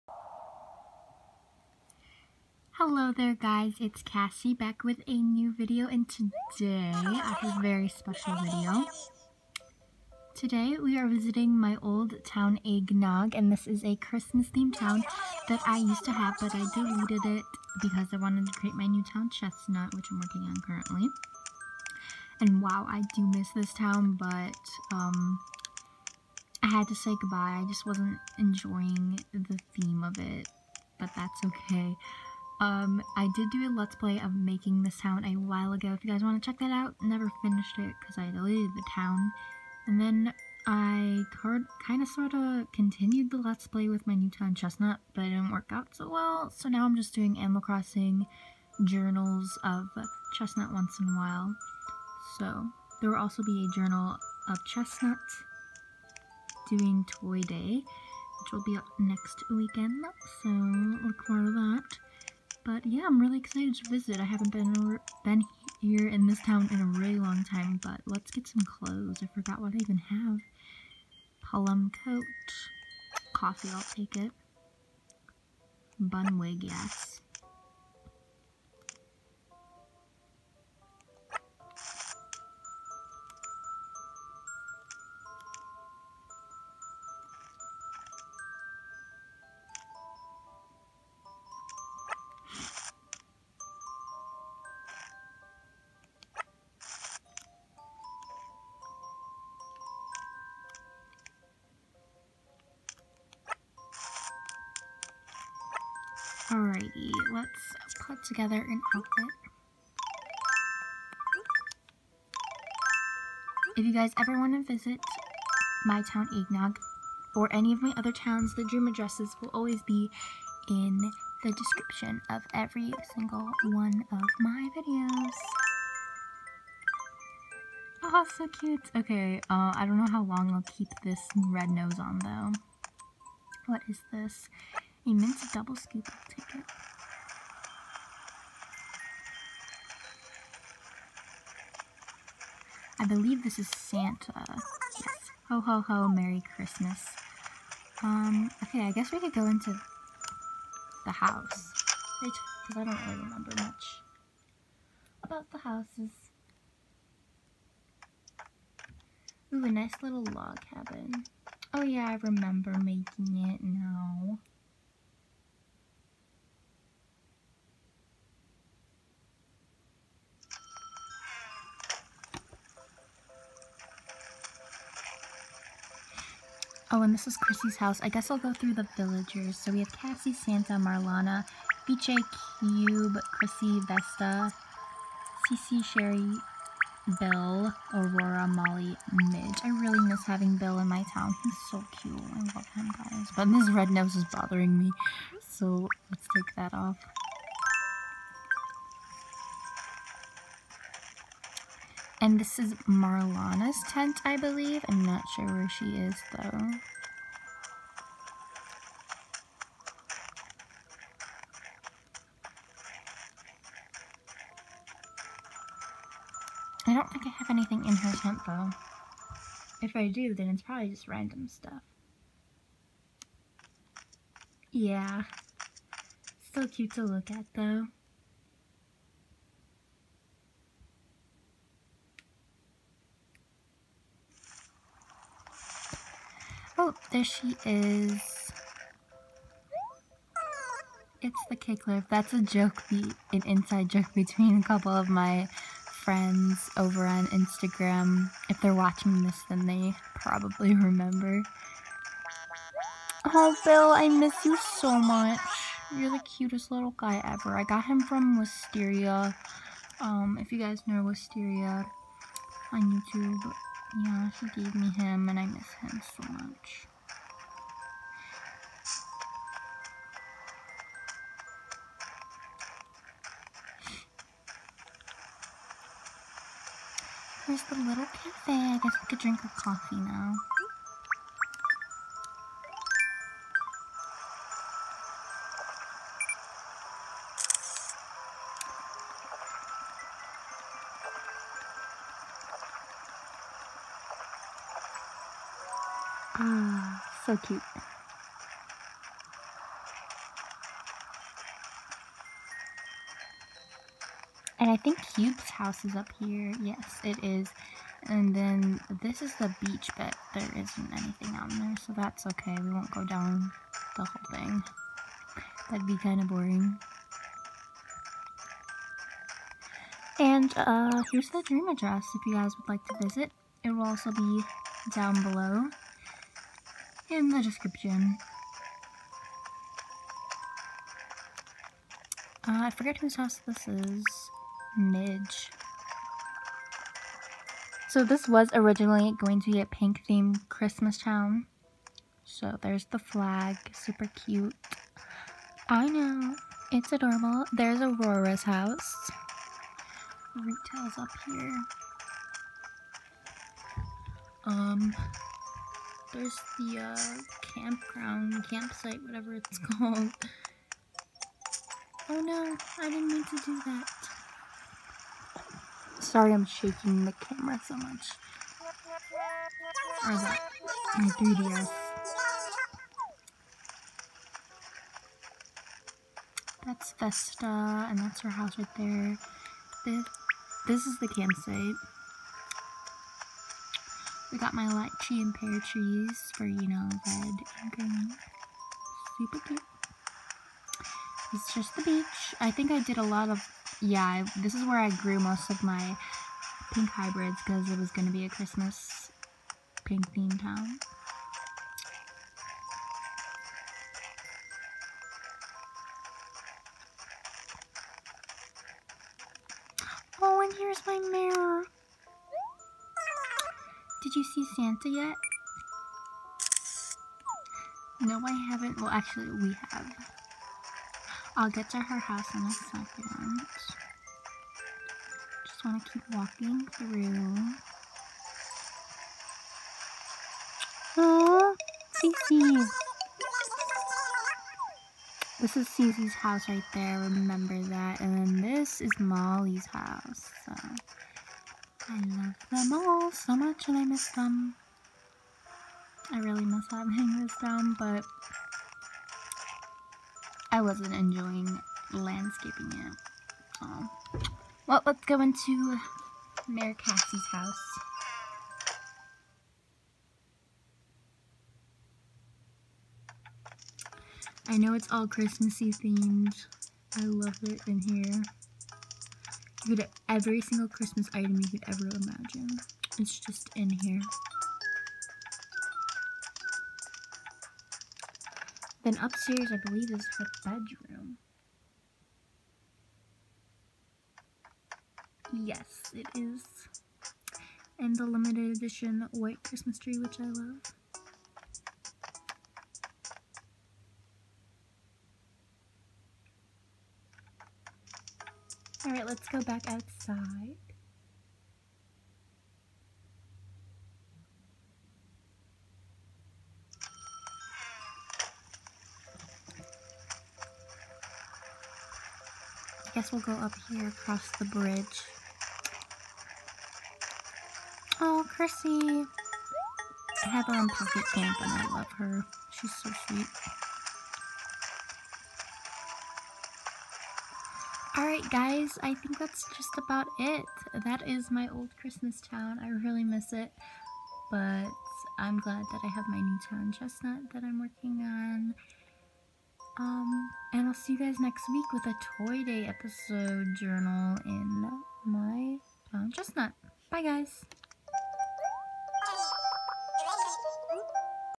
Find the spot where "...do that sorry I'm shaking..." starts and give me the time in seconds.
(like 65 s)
363 s.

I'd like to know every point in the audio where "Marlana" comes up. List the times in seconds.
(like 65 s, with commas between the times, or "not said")
180 s, 202 s.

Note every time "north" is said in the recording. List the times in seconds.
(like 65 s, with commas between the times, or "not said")
not said.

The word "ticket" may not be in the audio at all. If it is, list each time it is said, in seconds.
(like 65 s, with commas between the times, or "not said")
136 s.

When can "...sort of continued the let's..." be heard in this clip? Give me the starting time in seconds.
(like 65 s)
42 s.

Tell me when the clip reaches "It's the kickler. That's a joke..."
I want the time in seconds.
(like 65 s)
241 s.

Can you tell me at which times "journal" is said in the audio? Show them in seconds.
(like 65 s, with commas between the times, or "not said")
48 s, 53 s, 543 s.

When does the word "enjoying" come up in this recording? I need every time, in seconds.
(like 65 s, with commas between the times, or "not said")
28 s, 450 s.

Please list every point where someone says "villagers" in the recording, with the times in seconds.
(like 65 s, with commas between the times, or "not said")
178 s.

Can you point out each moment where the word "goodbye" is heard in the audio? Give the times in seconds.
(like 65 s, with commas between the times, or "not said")
27 s.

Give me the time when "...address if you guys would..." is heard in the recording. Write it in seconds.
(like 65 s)
321 s.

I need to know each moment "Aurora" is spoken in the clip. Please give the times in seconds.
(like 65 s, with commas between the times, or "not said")
187 s, 347 s.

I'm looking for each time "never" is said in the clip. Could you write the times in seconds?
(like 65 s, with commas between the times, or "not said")
37 s.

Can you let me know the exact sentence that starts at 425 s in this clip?
Just want to keep walking through.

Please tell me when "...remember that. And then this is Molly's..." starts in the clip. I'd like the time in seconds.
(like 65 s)
436 s.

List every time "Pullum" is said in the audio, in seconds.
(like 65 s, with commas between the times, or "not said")
71 s.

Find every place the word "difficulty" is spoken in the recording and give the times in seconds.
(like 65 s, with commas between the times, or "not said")
not said.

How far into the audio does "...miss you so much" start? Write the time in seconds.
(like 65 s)
254 s.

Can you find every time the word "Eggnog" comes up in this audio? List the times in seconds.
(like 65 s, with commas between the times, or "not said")
12 s, 116 s.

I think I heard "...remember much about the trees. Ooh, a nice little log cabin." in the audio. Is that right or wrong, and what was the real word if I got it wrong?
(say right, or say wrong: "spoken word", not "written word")
wrong: "houses", not "trees".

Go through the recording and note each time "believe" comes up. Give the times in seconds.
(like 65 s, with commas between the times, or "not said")
143 s, 204 s, 479 s.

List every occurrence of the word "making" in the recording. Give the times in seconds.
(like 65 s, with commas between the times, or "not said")
34 s, 162 s.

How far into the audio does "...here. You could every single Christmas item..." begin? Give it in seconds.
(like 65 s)
467 s.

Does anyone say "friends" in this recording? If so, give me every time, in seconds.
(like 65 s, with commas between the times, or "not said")
246 s.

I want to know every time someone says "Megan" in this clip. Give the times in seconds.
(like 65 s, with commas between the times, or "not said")
not said.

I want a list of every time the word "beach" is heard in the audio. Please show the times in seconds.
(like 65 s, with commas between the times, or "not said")
309 s, 391 s.